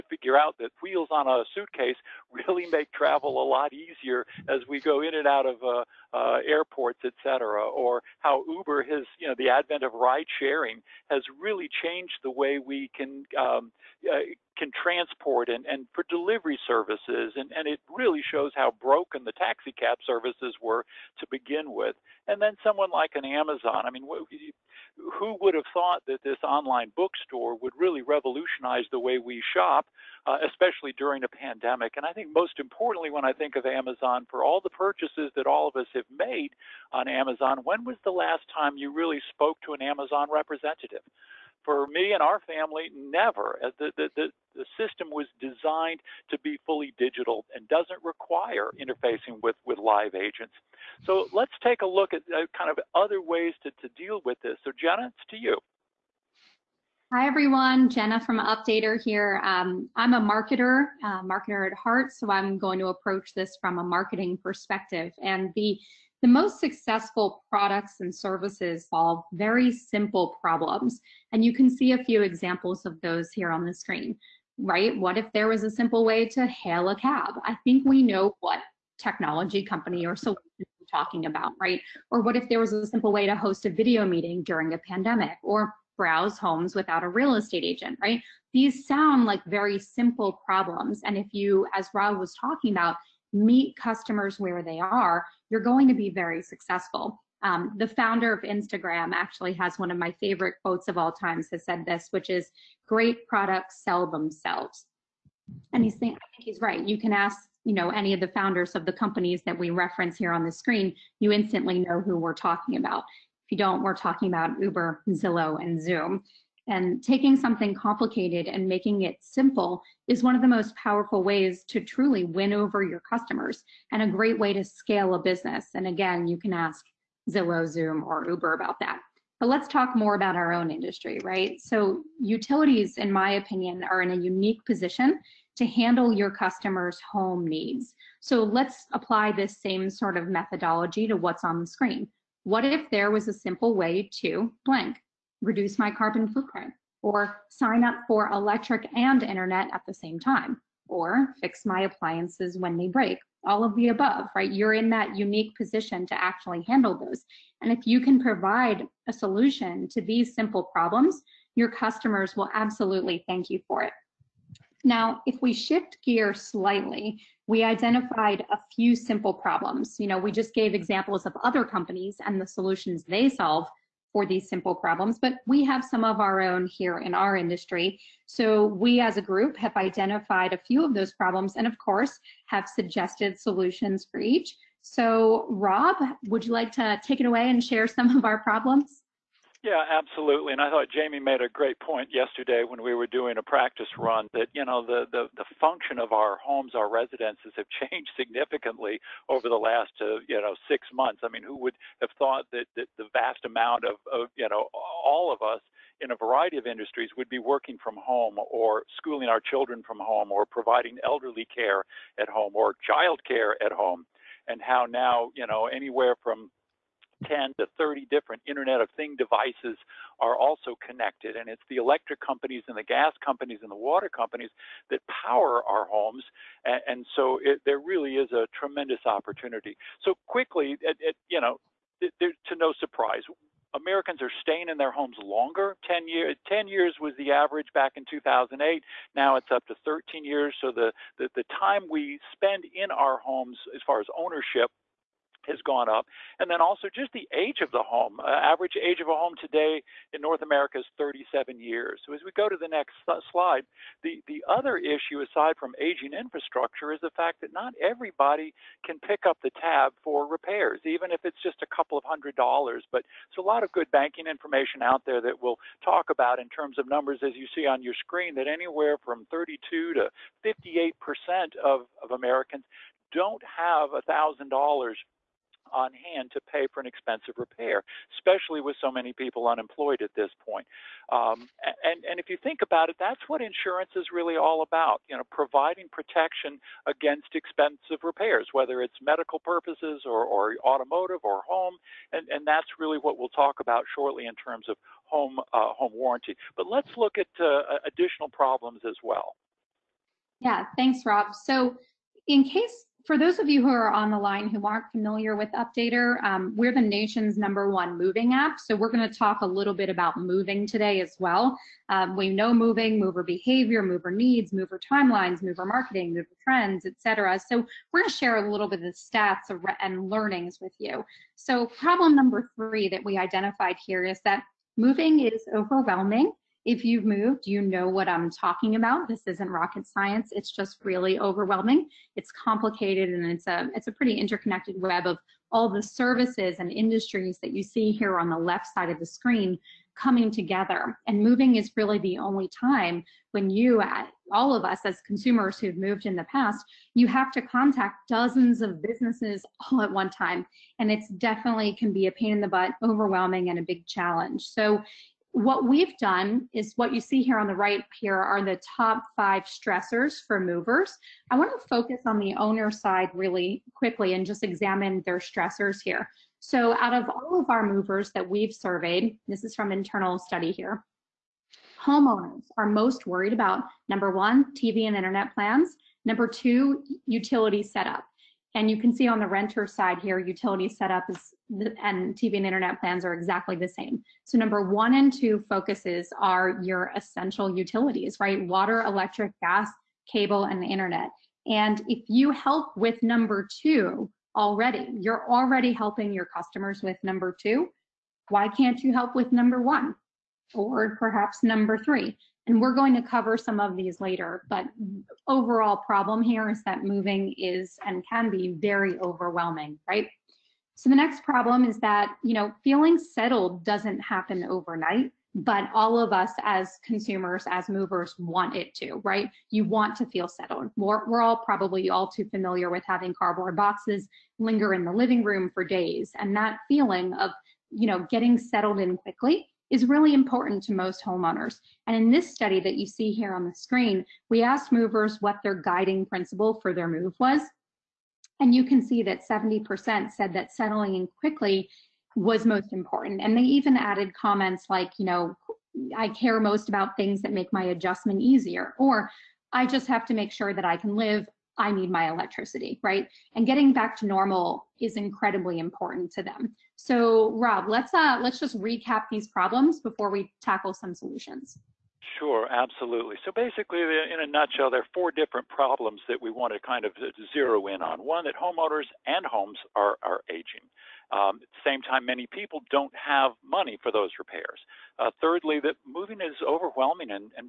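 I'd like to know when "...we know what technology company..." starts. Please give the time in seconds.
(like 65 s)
77 s.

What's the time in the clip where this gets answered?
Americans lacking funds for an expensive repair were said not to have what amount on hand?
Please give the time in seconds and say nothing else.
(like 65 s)
274 s.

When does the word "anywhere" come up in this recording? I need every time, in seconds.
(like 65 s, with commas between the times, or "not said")
215 s, 268 s.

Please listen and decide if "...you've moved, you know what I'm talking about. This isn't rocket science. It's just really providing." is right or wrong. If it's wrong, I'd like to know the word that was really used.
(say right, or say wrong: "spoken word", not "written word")
wrong: "overwhelming", not "providing".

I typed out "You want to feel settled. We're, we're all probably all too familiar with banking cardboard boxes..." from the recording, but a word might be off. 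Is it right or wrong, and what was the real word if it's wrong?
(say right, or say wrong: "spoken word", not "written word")
wrong: "having", not "banking".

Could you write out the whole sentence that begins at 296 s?
But let's look at uh, additional problems as well.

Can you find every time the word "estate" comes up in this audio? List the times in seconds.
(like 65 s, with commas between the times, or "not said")
87 s.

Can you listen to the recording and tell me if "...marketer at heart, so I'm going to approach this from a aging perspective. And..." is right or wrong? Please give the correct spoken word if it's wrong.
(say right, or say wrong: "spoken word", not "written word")
wrong: "marketing", not "aging".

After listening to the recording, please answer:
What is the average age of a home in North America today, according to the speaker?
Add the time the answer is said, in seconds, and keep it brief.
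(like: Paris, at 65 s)
37 years, at 250 s.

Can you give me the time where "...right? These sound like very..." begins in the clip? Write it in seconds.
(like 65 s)
88 s.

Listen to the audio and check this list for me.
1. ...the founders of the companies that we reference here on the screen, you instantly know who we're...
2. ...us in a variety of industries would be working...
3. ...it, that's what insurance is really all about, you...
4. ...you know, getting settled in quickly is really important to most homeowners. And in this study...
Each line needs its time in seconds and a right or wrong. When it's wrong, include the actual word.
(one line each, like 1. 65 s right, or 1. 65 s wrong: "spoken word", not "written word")
1. 108 s right
2. 205 s right
3. 282 s right
4. 427 s right.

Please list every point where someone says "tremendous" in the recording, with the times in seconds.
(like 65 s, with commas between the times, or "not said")
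228 s.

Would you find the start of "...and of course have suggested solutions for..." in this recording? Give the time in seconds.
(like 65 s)
181 s.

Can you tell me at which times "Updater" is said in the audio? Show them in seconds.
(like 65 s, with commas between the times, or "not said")
58 s, 305 s.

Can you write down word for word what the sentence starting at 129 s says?
But let's talk more about our own industry, right?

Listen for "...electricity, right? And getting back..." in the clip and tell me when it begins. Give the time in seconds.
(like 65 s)
452 s.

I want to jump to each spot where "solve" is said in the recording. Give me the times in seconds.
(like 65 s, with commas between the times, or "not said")
68 s, 173 s.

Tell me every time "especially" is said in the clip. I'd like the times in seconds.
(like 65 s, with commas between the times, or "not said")
30 s, 278 s.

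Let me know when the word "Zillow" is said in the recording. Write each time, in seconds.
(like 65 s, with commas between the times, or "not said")
115 s, 127 s.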